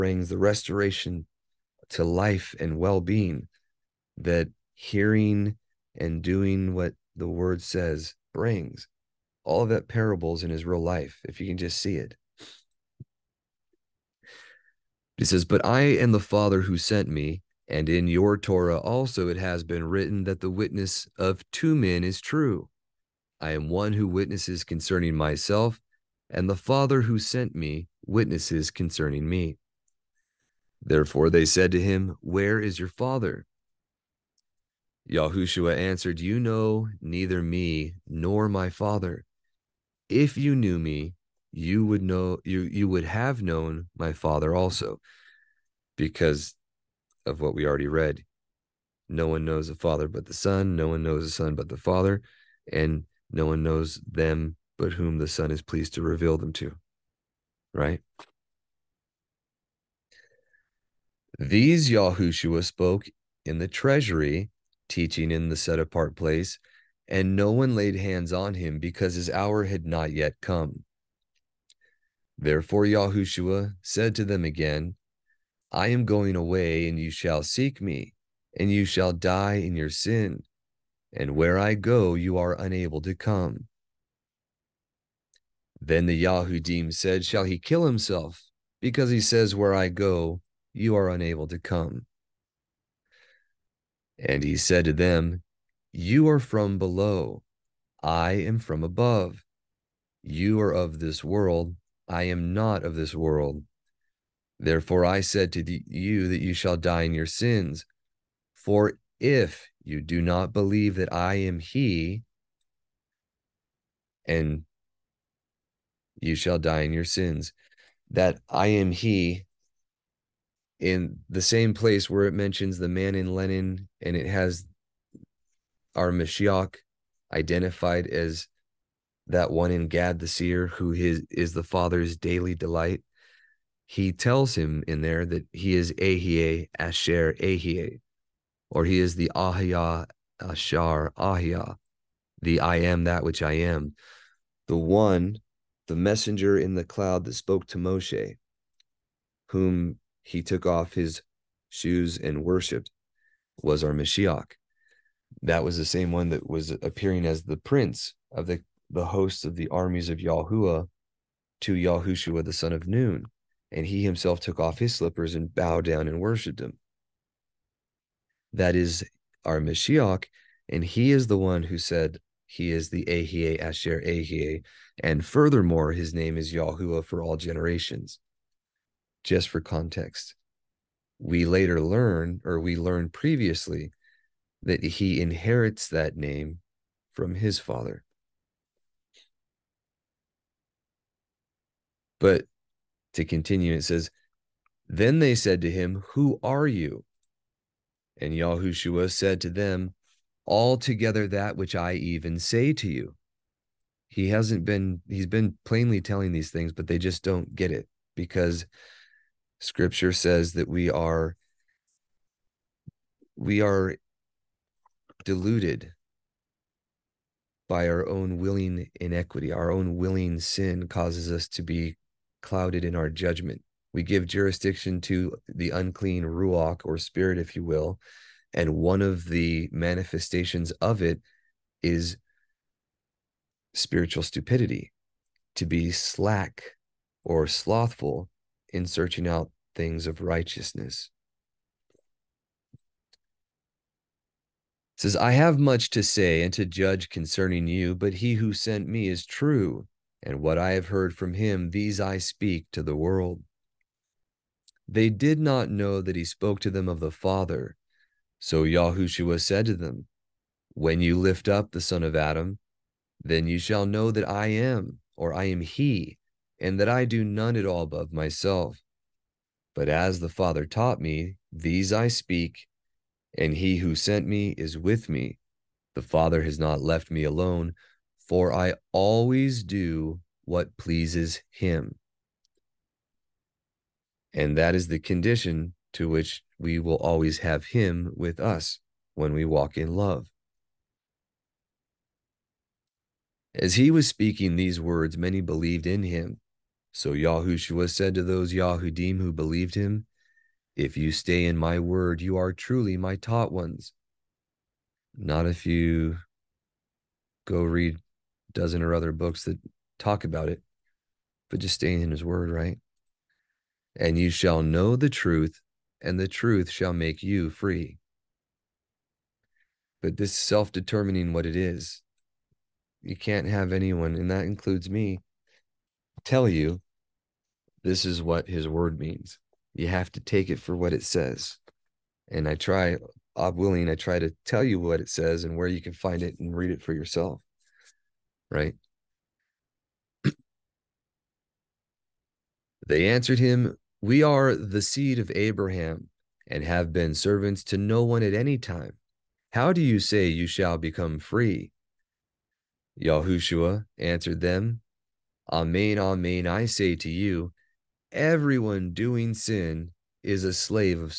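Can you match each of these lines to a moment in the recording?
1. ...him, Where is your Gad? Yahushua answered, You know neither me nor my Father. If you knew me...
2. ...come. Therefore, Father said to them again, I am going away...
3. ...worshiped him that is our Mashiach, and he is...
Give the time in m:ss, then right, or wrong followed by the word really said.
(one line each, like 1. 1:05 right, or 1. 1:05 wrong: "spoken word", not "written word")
1. 0:31 wrong: "Father", not "Gad"
2. 1:10 wrong: "Yahushua", not "Father"
3. 2:46 right.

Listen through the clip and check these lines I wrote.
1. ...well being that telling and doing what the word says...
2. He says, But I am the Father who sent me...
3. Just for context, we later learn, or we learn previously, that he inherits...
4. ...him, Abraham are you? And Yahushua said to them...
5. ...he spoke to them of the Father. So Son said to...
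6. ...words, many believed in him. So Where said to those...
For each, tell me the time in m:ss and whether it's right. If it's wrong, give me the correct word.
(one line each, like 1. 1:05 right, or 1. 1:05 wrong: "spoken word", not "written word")
1. 0:02 wrong: "hearing", not "telling"
2. 0:15 right
3. 2:59 right
4. 3:15 wrong: "Who", not "Abraham"
5. 4:16 wrong: "Yahushua", not "Son"
6. 4:54 wrong: "Yahushua", not "Where".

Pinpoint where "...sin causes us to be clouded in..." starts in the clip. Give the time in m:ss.
3:40.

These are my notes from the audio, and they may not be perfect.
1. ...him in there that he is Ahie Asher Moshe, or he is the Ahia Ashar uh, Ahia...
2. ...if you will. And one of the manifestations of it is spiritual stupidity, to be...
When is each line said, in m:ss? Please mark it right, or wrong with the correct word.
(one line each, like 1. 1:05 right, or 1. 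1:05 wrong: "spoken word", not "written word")
1. 2:14 wrong: "Ahie", not "Moshe"
2. 3:47 right.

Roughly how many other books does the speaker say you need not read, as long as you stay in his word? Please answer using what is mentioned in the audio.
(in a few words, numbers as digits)
12.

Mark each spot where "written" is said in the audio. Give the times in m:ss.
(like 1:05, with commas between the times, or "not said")
0:19.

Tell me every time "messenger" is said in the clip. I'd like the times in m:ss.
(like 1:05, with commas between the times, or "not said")
2:25.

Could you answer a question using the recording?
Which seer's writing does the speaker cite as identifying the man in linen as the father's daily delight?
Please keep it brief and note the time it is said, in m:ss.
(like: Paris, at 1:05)
Gad, at 2:09.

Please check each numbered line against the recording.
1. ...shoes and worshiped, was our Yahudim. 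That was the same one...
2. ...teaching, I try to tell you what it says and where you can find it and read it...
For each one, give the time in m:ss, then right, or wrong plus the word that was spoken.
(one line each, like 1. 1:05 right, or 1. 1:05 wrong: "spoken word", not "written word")
1. 2:31 wrong: "Mashiach", not "Yahudim"
2. 5:33 wrong: "willing", not "teaching".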